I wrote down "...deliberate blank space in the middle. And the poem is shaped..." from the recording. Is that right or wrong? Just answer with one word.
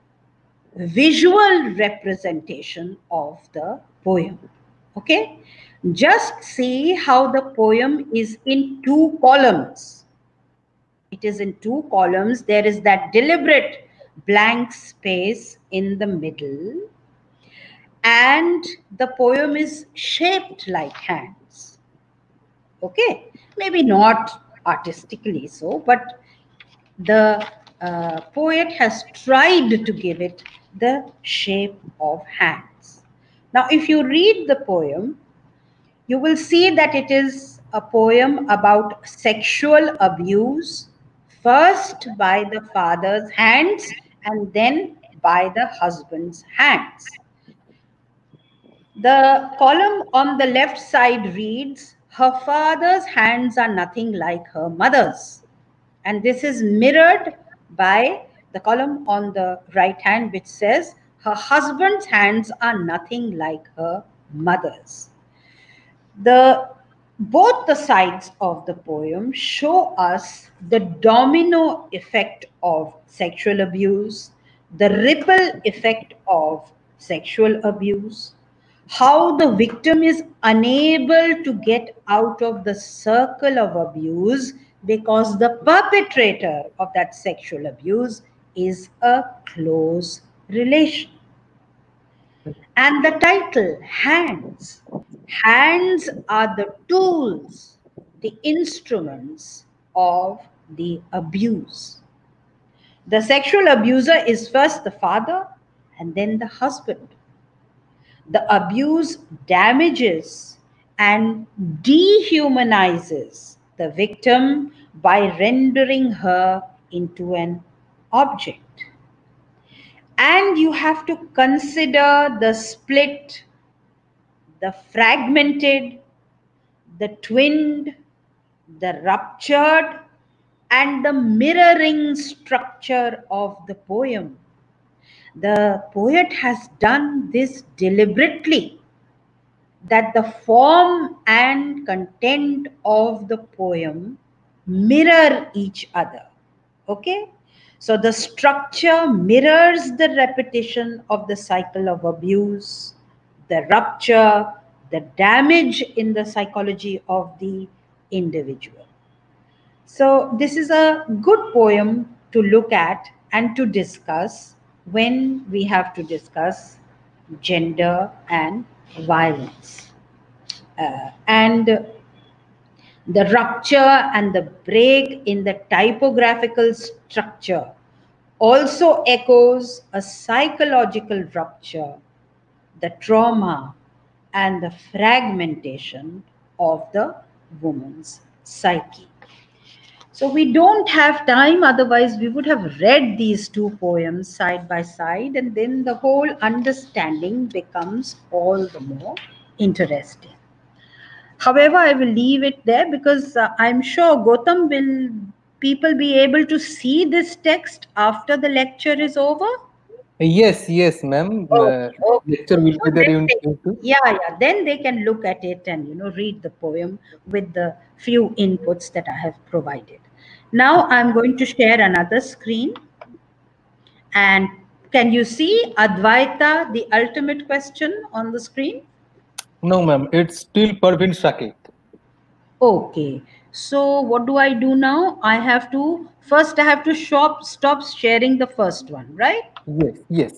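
right.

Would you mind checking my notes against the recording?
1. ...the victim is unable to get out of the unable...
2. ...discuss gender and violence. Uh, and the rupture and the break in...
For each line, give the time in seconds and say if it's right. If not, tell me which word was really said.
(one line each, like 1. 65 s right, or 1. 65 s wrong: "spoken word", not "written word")
1. 79 s wrong: "circle", not "unable"
2. 166 s right.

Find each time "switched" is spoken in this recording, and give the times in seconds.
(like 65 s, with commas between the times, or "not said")
not said.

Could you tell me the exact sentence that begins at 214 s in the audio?
Then they can look at it and you know read the poem with the few inputs that I have provided.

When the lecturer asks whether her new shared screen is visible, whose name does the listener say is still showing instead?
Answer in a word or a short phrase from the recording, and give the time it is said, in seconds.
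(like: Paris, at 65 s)
Pervin Saket, at 230 s.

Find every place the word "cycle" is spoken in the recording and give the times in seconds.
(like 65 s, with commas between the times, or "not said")
151 s.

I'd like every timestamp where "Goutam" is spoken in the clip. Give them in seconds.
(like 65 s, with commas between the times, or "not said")
204 s.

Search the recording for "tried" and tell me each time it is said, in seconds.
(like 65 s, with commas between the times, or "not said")
29 s.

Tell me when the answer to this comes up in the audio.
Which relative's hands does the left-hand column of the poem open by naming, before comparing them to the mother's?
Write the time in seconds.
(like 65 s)
52 s.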